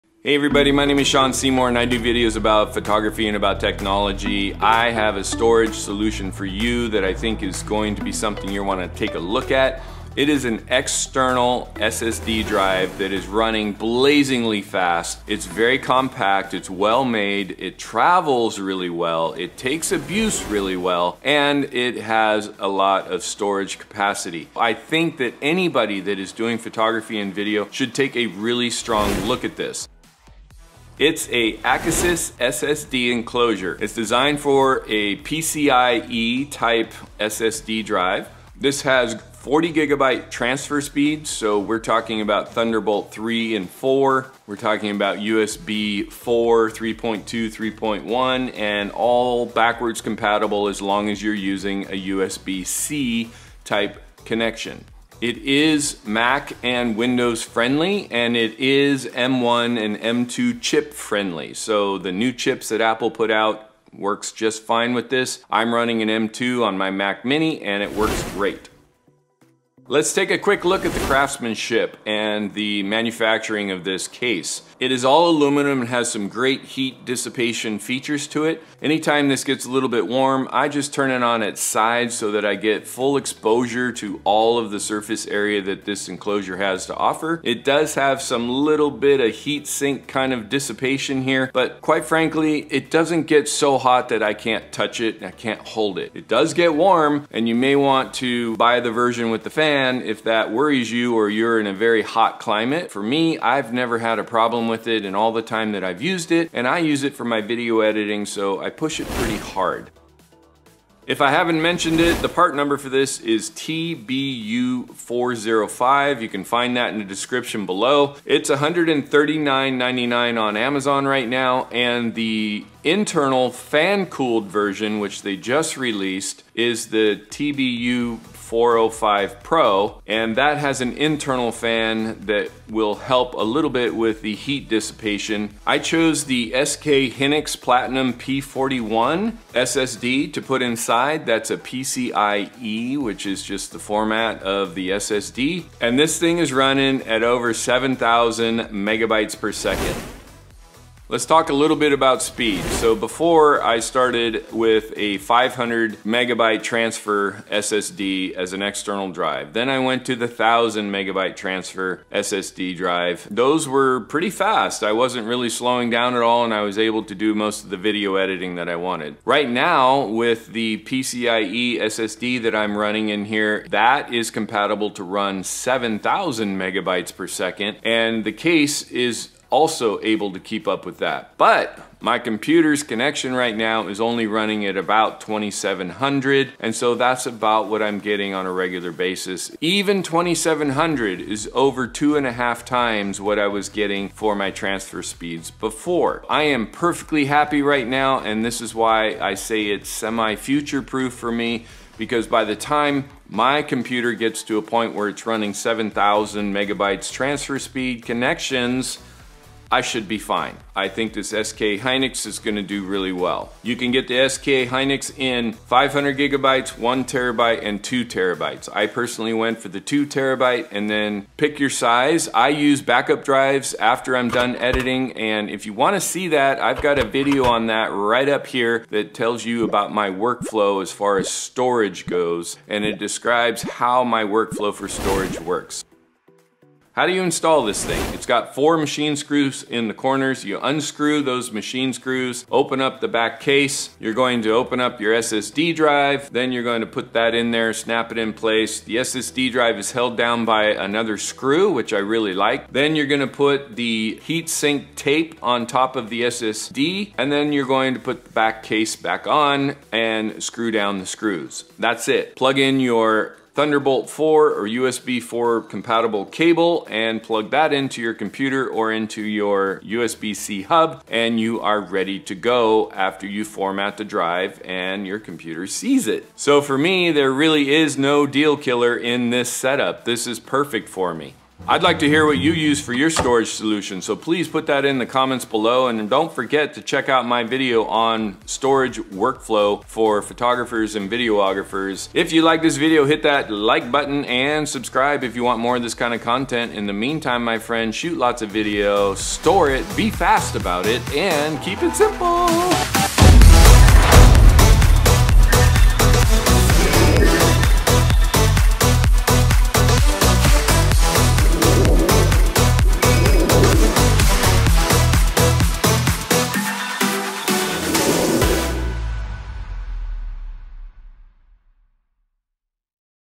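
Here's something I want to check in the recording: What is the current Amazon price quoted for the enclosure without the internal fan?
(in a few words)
$139.99.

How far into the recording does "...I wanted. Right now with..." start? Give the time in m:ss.
2:48.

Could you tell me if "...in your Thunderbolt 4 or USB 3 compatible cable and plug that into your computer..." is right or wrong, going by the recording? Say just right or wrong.
wrong.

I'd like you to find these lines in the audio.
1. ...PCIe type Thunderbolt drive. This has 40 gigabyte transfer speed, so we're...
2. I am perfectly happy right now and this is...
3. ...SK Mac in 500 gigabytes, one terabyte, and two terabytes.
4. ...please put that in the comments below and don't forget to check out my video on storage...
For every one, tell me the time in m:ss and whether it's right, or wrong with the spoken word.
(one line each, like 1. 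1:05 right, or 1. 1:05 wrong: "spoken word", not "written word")
1. 0:35 wrong: "SSD", not "Thunderbolt"
2. 3:16 right
3. 3:34 wrong: "Hynix", not "Mac"
4. 4:44 right.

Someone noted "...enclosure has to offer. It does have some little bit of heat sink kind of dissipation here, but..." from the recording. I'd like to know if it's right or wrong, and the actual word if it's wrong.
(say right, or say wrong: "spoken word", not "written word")
right.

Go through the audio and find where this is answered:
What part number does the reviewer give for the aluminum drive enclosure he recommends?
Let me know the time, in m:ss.
1:53.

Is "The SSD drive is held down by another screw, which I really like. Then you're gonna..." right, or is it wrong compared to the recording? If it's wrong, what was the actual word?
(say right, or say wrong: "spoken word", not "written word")
right.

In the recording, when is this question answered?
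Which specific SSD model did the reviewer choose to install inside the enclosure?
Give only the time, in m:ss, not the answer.
2:16.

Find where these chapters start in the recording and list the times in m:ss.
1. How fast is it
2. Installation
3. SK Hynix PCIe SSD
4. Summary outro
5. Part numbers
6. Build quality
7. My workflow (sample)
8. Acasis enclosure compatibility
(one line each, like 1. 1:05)
1. 2:29
2. 3:54
3. 3:30
4. 4:35
5. 1:48
6. 1:07
7. 3:43
8. 0:24.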